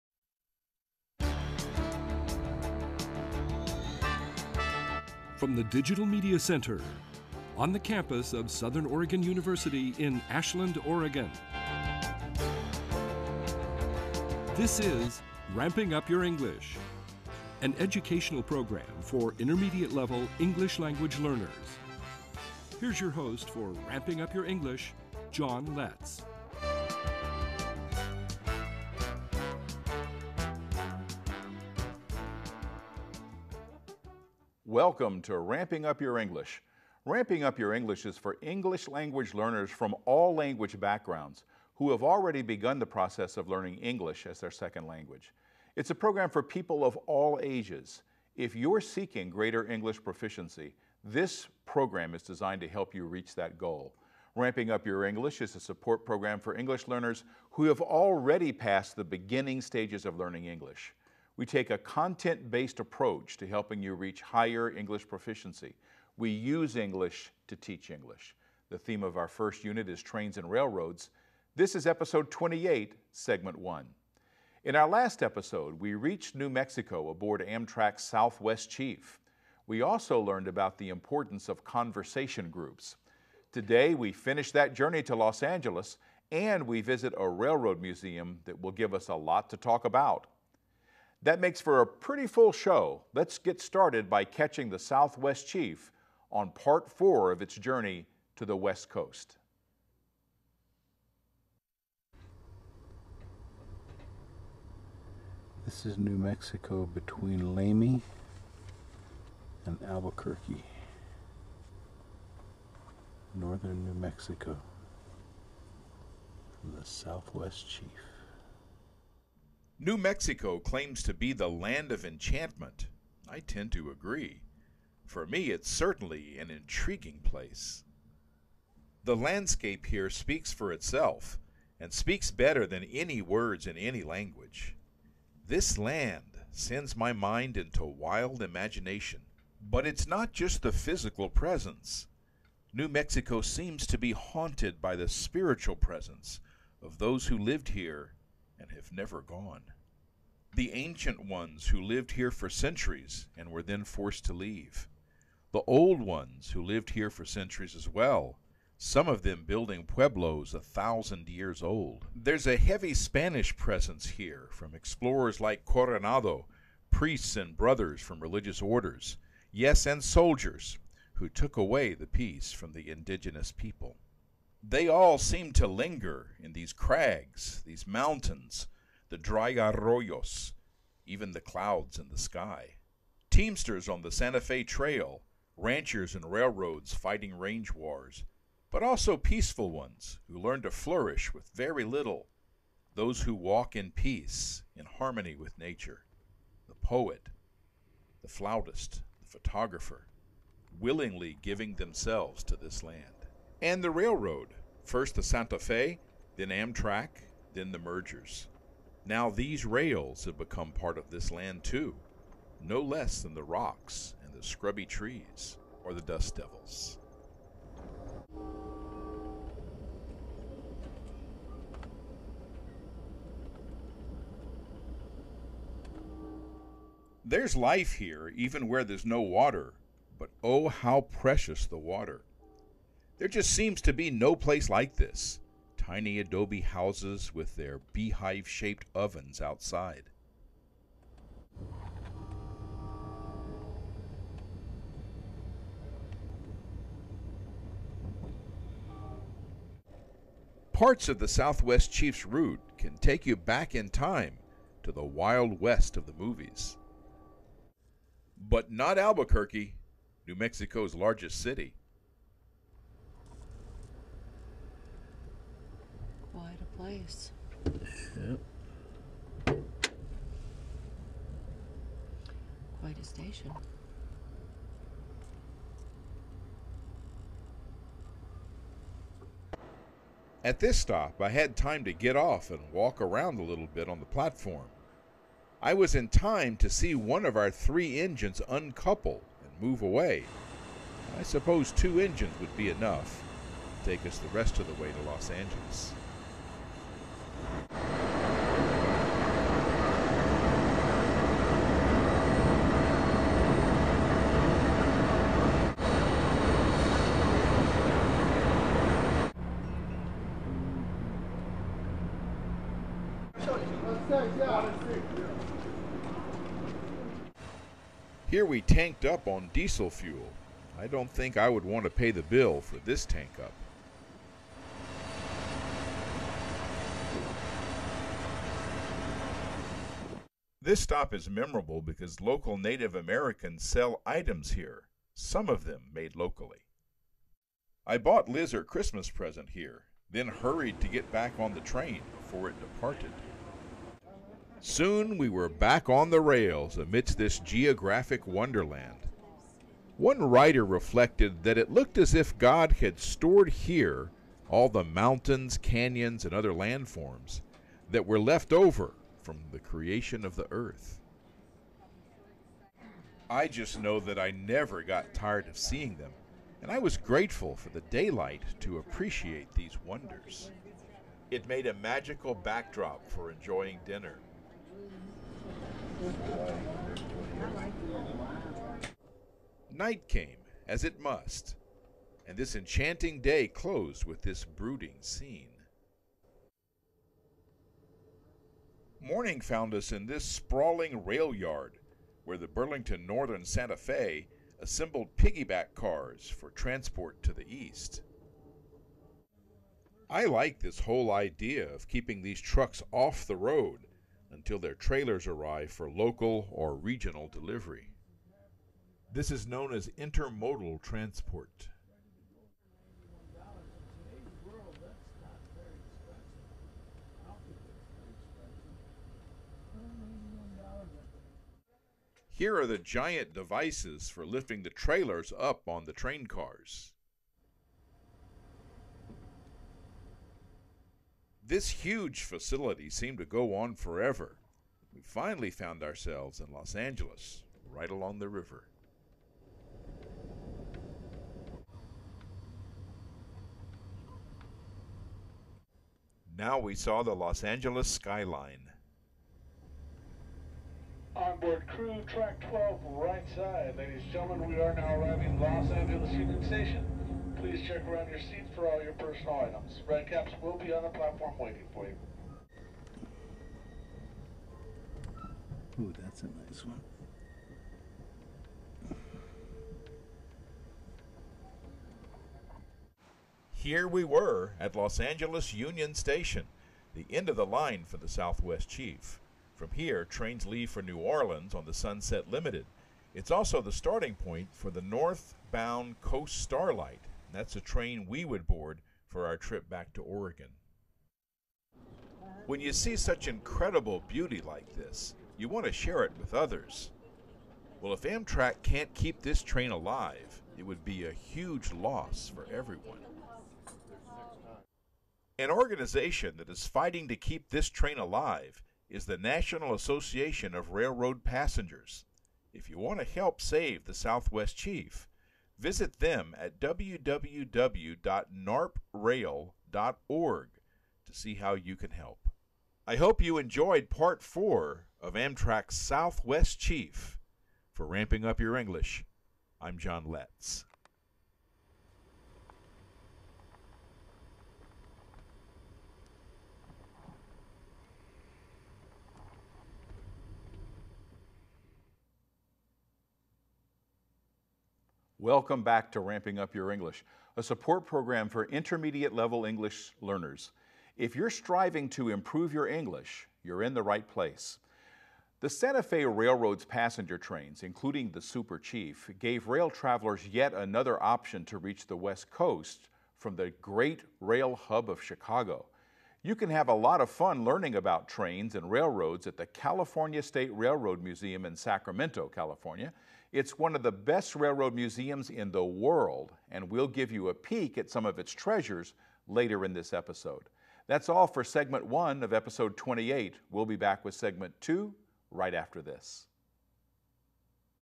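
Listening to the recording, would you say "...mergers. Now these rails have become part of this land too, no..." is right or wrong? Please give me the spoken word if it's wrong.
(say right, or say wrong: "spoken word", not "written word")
right.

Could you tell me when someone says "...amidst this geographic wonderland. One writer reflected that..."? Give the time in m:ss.
5:46.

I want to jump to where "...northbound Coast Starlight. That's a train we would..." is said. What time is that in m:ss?
8:04.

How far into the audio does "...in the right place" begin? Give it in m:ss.
9:13.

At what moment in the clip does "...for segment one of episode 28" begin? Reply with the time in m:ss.
9:41.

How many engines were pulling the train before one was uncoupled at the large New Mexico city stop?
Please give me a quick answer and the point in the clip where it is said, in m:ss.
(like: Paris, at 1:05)
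3, at 4:47.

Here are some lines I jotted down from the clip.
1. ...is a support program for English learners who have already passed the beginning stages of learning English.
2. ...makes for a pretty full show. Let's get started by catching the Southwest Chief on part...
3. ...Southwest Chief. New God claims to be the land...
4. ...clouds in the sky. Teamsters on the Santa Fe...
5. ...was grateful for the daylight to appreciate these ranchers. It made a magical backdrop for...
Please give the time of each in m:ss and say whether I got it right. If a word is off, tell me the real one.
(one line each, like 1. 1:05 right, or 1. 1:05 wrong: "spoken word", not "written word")
1. 0:55 right
2. 1:31 right
3. 1:56 wrong: "Mexico", not "God"
4. 3:01 right
5. 6:06 wrong: "wonders", not "ranchers".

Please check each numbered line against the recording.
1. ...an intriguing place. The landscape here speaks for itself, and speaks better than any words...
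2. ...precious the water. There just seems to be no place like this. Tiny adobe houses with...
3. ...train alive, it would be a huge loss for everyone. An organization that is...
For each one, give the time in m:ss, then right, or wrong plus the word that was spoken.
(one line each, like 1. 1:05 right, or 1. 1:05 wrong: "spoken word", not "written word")
1. 2:06 right
2. 3:51 right
3. 8:19 right.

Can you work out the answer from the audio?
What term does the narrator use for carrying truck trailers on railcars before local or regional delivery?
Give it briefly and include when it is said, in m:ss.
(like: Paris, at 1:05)
Intermodal transport, at 6:49.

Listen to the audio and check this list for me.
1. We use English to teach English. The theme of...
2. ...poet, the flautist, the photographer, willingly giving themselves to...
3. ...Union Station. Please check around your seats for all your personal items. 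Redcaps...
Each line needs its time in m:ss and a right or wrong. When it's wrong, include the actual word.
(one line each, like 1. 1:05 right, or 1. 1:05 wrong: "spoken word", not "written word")
1. 1:06 right
2. 3:16 right
3. 7:36 right.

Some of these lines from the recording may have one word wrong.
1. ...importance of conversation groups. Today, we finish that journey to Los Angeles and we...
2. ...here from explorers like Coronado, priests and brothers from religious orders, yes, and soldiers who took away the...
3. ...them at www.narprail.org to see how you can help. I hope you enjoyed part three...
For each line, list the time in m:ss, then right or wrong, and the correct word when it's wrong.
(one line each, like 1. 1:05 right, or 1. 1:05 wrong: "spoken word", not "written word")
1. 1:20 right
2. 2:44 right
3. 8:35 wrong: "four", not "three".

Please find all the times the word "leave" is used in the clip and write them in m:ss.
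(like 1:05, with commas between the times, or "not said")
2:34, 8:00.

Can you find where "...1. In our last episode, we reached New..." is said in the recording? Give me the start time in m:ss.
1:13.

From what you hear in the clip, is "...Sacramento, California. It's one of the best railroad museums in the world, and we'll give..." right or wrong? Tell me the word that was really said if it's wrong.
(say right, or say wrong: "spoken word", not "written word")
right.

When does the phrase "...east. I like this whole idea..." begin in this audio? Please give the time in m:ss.
6:37.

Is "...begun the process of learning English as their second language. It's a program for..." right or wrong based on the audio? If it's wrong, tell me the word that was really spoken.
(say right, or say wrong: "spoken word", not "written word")
right.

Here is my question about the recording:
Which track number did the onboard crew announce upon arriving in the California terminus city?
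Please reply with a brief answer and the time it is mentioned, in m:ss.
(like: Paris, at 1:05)
12, at 7:32.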